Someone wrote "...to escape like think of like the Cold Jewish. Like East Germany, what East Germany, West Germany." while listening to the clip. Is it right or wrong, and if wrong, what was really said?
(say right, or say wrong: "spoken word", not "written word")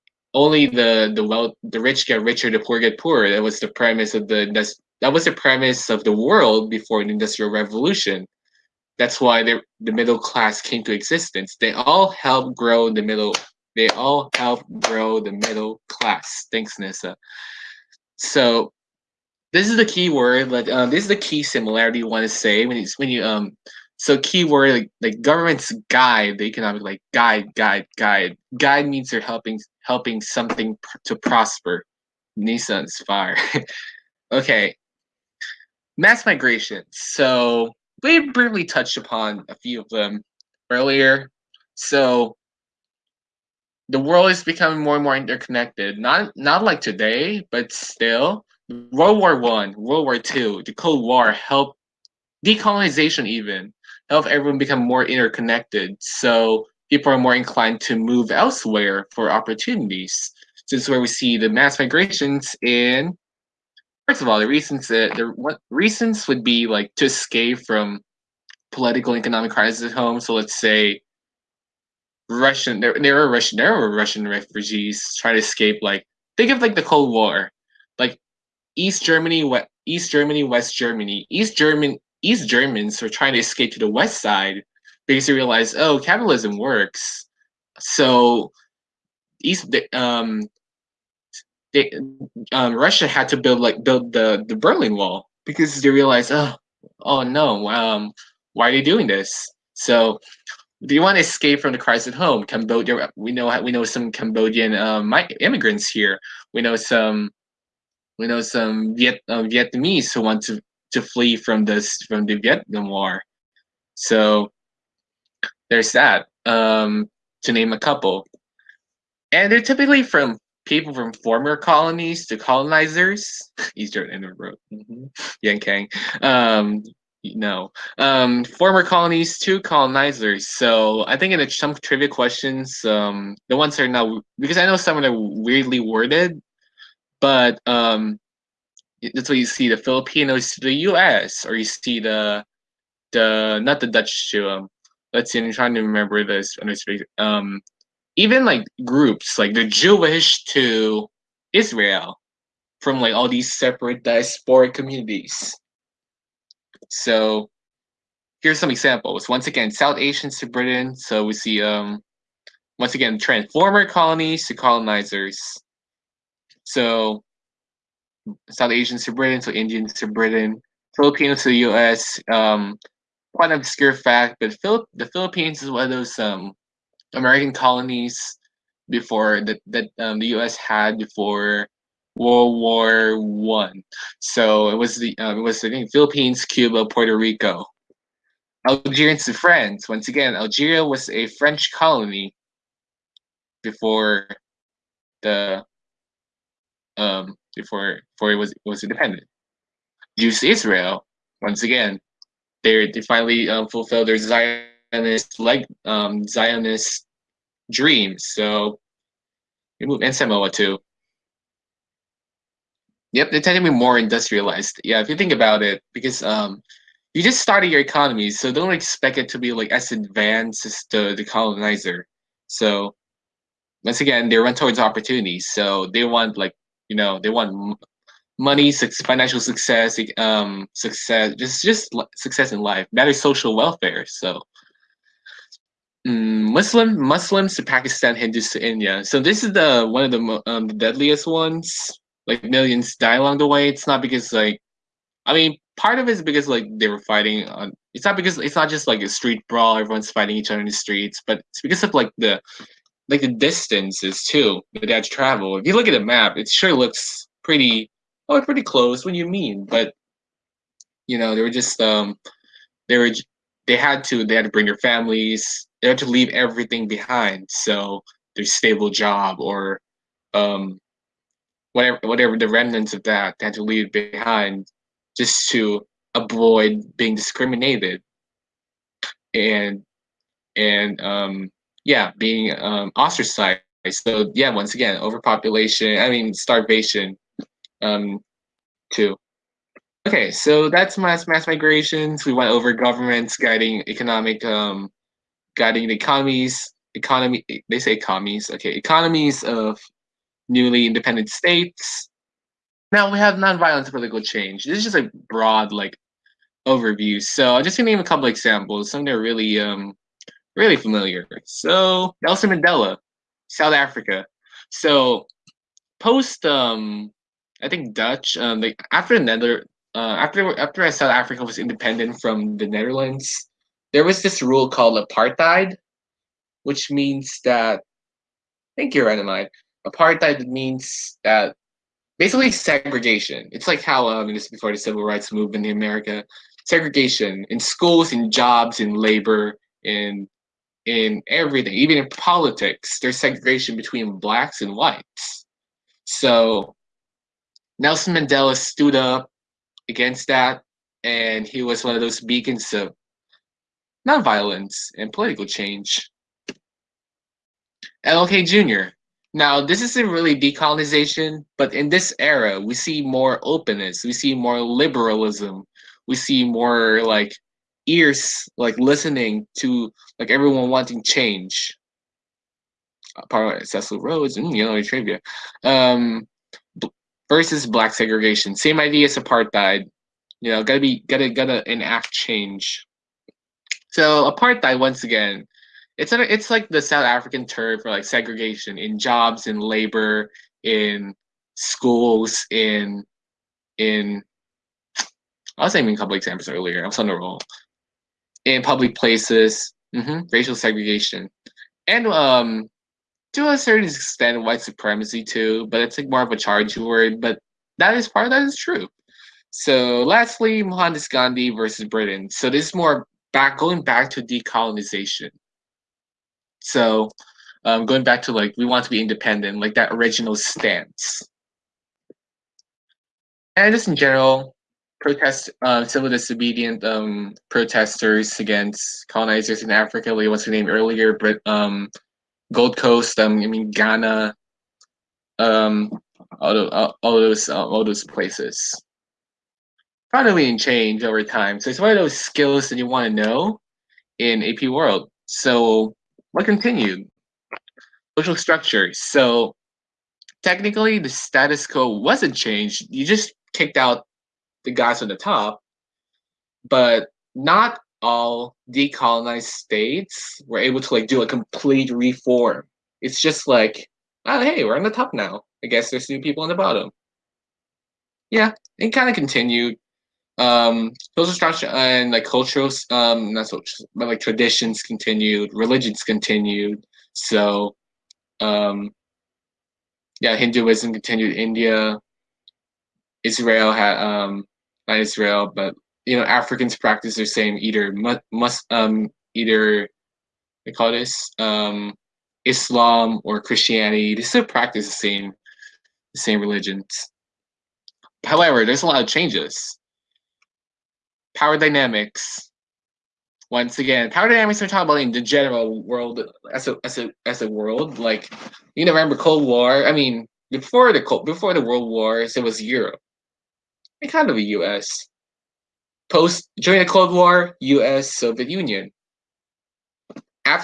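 wrong: "War", not "Jewish".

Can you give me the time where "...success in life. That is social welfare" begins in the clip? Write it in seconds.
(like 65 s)
232 s.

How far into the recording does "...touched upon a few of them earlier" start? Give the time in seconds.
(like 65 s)
38 s.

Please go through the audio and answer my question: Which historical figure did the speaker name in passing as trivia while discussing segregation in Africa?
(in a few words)
Cecil Rhodes.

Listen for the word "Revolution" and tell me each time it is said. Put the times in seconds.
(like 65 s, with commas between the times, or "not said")
7 s.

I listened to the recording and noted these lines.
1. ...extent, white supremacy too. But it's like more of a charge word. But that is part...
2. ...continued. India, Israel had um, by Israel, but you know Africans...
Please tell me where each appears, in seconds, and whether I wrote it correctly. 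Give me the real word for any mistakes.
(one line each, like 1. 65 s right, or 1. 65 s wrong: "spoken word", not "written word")
1. 403 s right
2. 480 s right.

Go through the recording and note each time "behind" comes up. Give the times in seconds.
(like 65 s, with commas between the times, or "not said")
266 s, 273 s.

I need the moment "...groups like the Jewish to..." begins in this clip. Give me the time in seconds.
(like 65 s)
148 s.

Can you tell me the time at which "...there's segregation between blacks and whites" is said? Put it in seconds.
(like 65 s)
342 s.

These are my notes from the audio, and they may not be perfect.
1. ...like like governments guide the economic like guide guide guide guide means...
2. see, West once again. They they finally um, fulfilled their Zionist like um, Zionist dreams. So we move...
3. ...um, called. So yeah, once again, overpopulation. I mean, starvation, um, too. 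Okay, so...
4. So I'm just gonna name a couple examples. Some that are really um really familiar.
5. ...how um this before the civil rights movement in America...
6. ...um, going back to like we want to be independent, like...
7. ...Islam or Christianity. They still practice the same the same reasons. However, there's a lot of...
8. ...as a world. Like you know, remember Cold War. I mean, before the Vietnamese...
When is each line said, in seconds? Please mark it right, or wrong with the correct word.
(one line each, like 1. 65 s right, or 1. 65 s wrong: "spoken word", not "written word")
1. 24 s right
2. 200 s wrong: "Israel", not "West"
3. 282 s wrong: "ostracized", not "called"
4. 307 s right
5. 333 s right
6. 417 s right
7. 492 s wrong: "religions", not "reasons"
8. 507 s wrong: "Cold", not "Vietnamese".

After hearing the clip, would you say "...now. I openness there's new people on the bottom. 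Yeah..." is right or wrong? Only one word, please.
wrong.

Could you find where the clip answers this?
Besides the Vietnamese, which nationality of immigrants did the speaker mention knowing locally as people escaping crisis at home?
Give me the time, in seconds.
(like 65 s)
104 s.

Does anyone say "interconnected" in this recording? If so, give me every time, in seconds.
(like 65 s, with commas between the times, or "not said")
45 s, 55 s.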